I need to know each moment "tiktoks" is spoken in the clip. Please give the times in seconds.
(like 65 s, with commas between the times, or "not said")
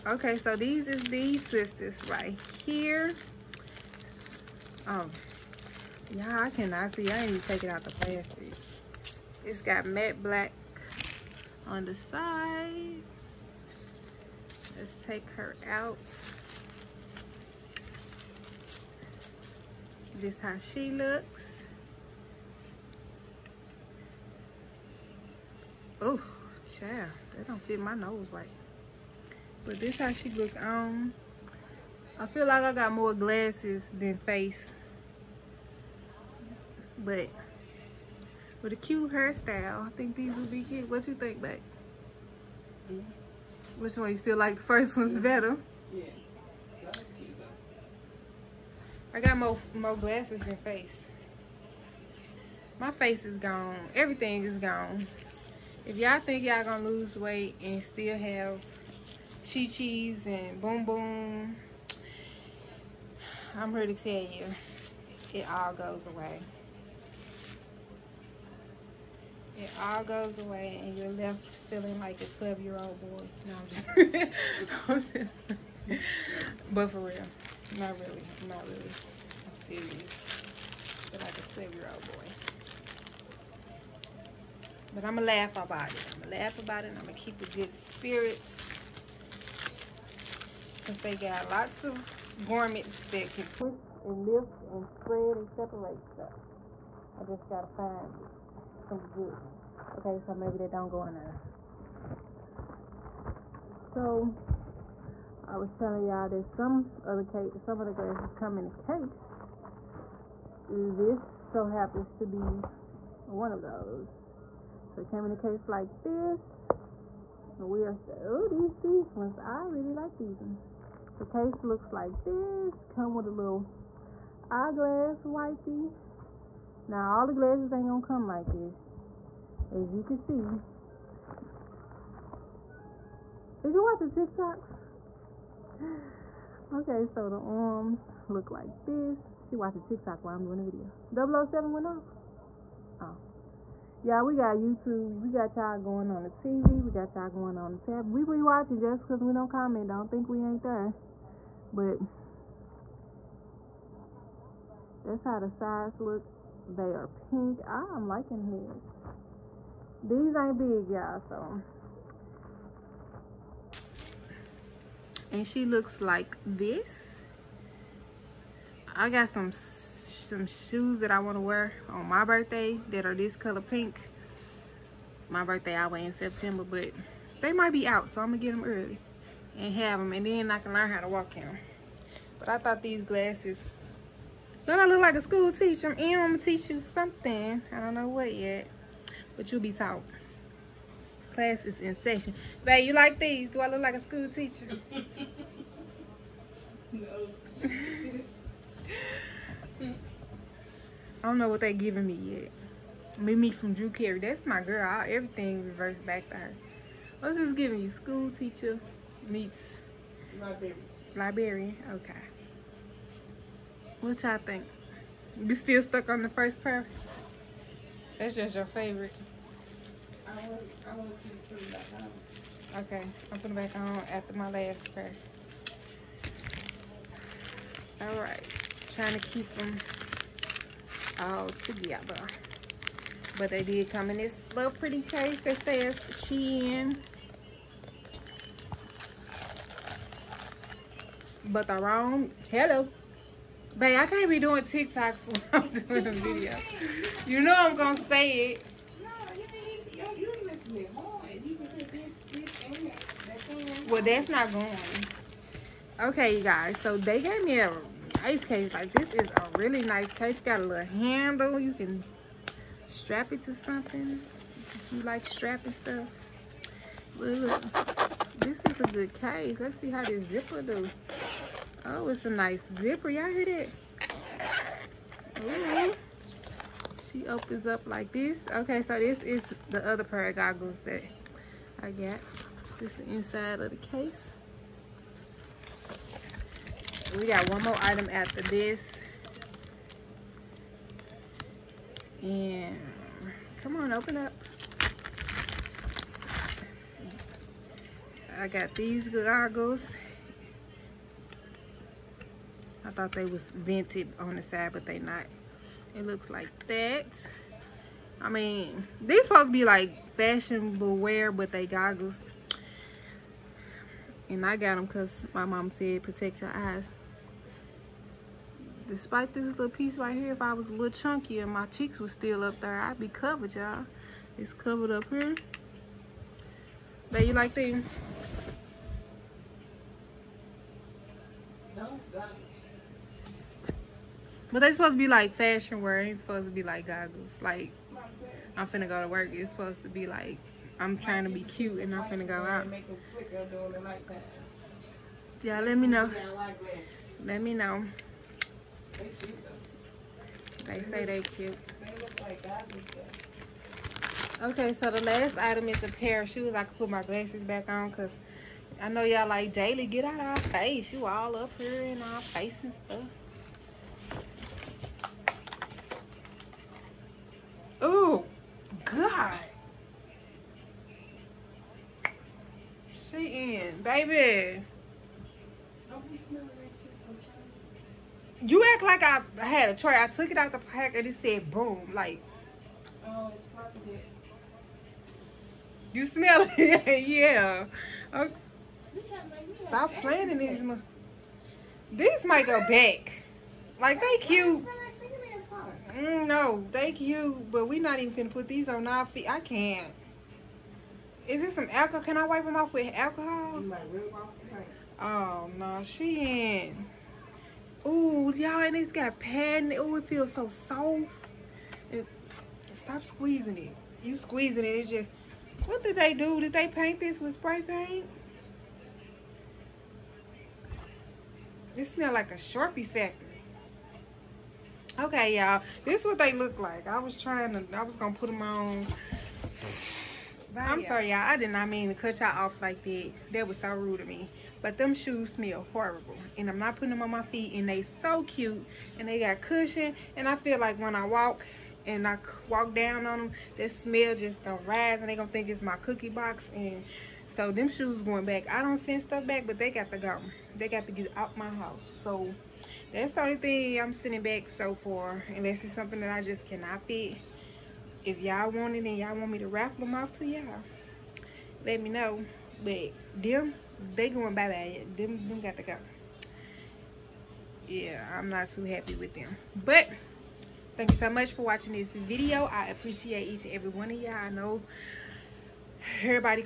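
134 s, 139 s, 244 s.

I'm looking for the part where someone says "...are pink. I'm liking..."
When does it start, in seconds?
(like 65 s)
156 s.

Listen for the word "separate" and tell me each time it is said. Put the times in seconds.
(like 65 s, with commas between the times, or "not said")
95 s.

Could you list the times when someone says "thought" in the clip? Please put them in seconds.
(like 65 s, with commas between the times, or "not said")
182 s, 302 s.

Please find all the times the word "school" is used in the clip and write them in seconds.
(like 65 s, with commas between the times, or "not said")
185 s, 194 s, 208 s.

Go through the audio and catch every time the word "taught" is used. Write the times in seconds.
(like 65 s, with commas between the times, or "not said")
189 s.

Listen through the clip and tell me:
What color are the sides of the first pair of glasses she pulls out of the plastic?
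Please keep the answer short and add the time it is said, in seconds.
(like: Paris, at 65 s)
Matte black, at 9 s.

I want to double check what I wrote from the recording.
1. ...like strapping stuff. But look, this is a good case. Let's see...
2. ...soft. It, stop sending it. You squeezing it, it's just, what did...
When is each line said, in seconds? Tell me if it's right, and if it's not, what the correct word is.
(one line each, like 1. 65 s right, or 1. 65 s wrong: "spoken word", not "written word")
1. 265 s right
2. 410 s wrong: "squeezing", not "sending".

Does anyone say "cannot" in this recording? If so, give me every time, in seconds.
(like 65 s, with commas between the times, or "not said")
6 s, 456 s.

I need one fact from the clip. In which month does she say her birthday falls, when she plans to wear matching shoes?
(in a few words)
September.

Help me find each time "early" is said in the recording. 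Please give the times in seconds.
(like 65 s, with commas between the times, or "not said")
178 s.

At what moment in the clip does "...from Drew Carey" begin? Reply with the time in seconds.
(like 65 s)
203 s.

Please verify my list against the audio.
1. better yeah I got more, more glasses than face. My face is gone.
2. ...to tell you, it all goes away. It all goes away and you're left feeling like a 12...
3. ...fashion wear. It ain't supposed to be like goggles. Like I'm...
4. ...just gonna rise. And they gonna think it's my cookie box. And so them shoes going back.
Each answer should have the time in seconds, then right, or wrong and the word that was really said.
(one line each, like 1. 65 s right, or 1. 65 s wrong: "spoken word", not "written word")
1. 45 s right
2. 63 s right
3. 335 s right
4. 444 s right.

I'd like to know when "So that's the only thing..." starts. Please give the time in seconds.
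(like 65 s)
452 s.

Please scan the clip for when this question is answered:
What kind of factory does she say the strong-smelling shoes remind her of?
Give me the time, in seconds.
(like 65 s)
422 s.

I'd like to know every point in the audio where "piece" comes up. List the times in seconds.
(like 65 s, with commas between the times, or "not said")
319 s.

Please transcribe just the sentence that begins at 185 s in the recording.
I'm in, I'm gonna teach you something.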